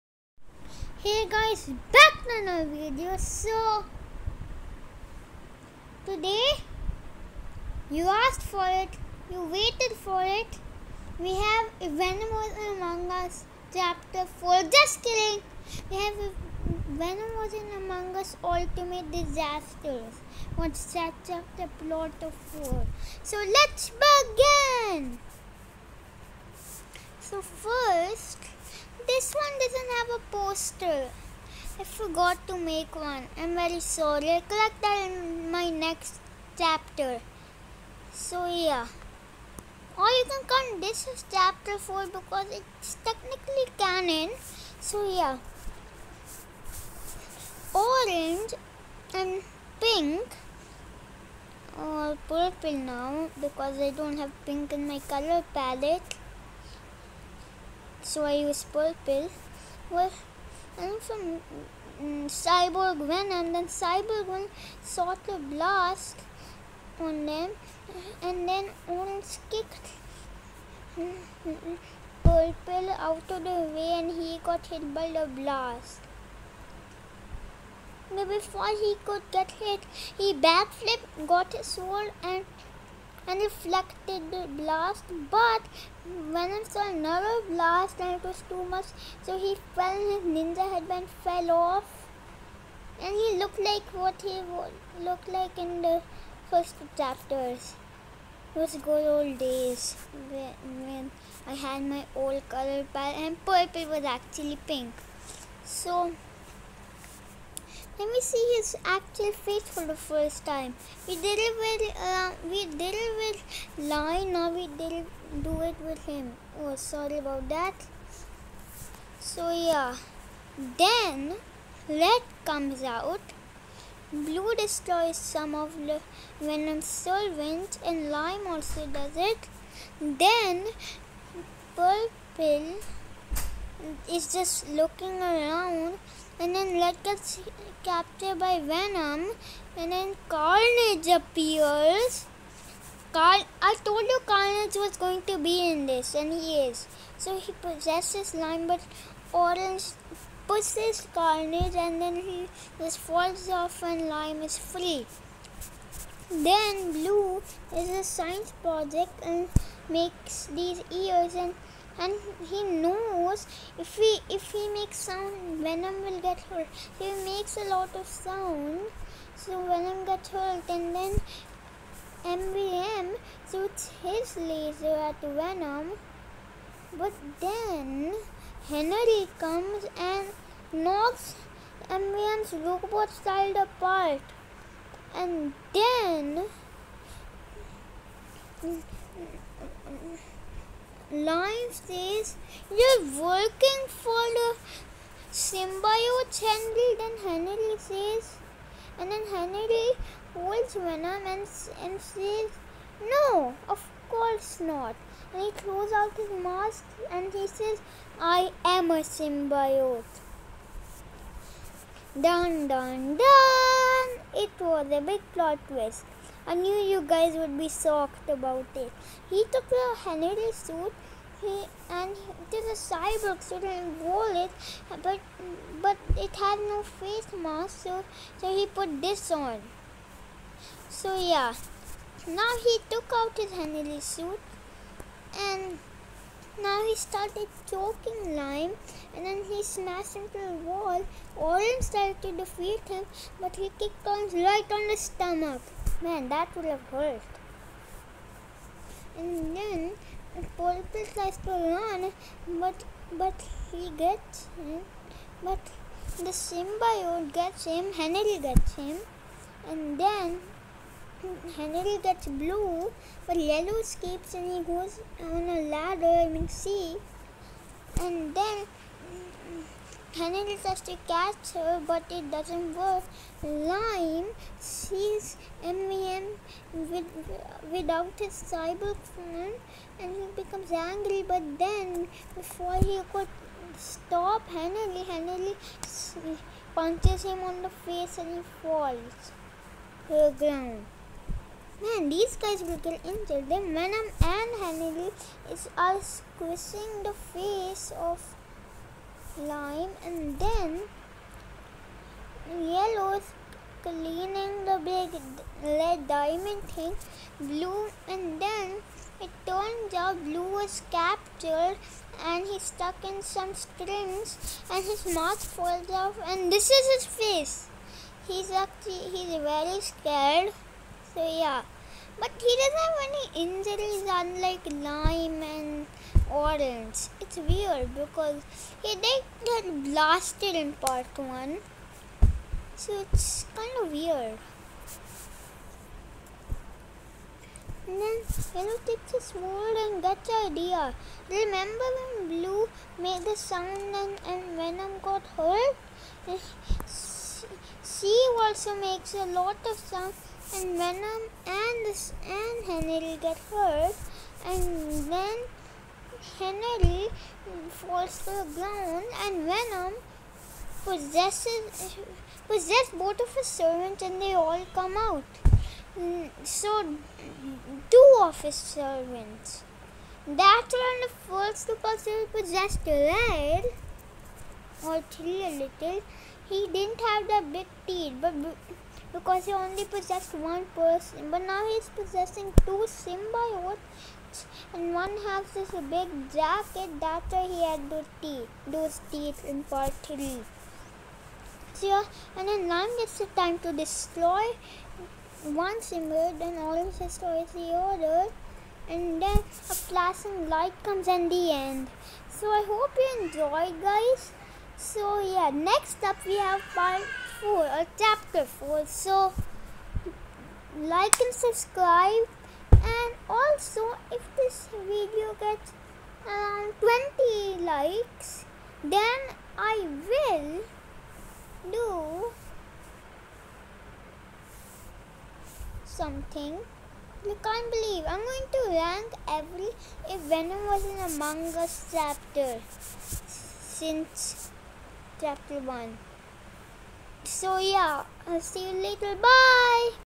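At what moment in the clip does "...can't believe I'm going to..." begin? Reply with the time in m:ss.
7:07.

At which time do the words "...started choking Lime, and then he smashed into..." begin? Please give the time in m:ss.
3:56.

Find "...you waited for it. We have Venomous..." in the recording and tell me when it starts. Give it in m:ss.
0:09.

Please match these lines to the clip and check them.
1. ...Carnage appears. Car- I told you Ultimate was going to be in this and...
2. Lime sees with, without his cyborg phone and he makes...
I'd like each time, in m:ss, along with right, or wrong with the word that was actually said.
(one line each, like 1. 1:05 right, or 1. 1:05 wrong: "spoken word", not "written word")
1. 2:20 wrong: "Carnage", not "Ultimate"
2. 4:33 wrong: "becomes", not "makes".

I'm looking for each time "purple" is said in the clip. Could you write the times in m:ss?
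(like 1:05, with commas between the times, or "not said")
0:52, 0:58, 1:12, 1:43, 2:11, 4:10.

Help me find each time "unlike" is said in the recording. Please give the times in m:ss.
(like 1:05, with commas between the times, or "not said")
5:24.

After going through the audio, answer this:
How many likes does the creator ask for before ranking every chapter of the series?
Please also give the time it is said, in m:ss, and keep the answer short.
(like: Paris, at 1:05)
20, at 6:57.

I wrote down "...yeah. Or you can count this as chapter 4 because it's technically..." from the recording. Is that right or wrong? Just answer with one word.
right.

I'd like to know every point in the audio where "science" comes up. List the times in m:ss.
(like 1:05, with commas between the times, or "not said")
2:38.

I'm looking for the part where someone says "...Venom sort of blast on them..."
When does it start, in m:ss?
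1:04.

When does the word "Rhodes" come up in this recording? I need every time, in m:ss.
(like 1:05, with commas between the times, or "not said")
not said.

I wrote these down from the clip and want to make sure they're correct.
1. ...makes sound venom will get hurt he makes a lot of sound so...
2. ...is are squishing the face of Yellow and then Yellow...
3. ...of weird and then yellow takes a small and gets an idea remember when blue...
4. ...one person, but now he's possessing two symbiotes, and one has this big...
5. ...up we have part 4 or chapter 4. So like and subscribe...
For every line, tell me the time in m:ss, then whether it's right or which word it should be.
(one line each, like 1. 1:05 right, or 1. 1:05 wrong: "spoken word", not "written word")
1. 2:44 right
2. 4:55 wrong: "Lime", not "Yellow"
3. 5:33 right
4. 6:20 right
5. 6:46 right.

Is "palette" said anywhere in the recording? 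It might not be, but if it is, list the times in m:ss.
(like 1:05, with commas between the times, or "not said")
0:55, 1:42.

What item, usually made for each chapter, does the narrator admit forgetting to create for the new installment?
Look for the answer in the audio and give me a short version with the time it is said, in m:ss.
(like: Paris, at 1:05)
A poster, at 0:30.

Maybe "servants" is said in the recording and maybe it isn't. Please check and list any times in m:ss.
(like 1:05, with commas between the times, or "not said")
6:03, 6:08.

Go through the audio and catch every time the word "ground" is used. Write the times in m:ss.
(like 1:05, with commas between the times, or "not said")
4:50, 5:58.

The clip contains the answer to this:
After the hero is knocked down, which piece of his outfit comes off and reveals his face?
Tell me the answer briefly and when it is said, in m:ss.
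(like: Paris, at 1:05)
Ninja headband, at 1:30.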